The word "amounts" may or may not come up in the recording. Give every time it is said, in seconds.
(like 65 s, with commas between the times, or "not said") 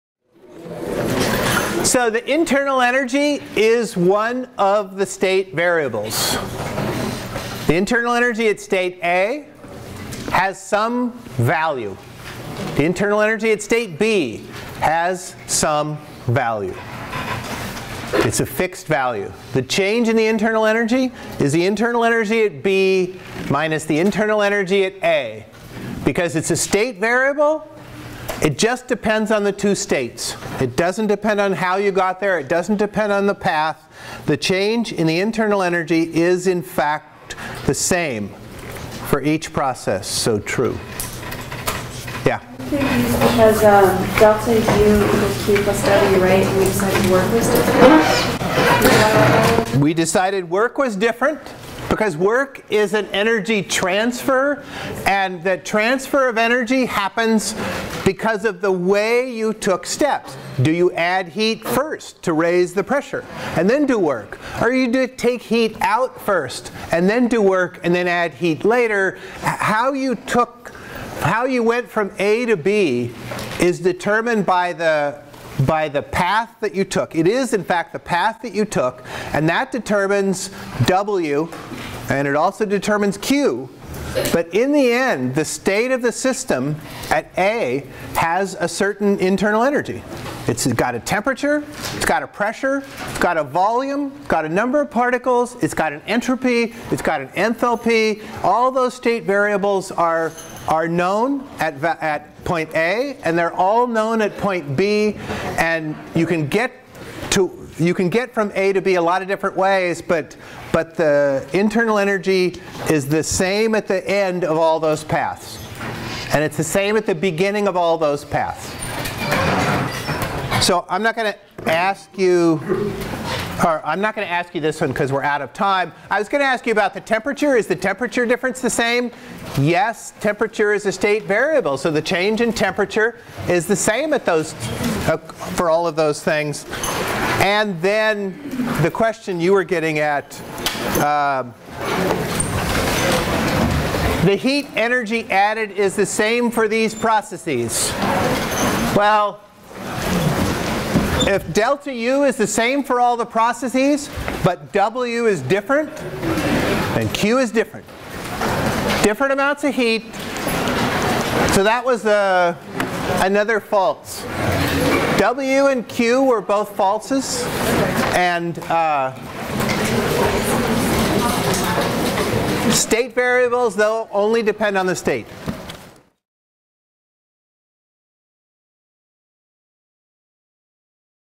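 159 s.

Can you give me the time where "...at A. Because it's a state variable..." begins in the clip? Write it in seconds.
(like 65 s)
24 s.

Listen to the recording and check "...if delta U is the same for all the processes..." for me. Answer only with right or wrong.
right.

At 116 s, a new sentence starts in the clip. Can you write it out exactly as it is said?
And it's the same at the beginning of all those paths.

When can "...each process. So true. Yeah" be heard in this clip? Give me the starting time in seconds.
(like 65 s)
39 s.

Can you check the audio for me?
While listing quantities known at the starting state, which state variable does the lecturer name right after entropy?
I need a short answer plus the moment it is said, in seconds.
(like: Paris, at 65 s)
Enthalpy, at 97 s.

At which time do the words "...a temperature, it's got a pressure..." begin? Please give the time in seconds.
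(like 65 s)
90 s.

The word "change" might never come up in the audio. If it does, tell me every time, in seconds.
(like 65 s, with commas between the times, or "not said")
19 s, 34 s, 132 s.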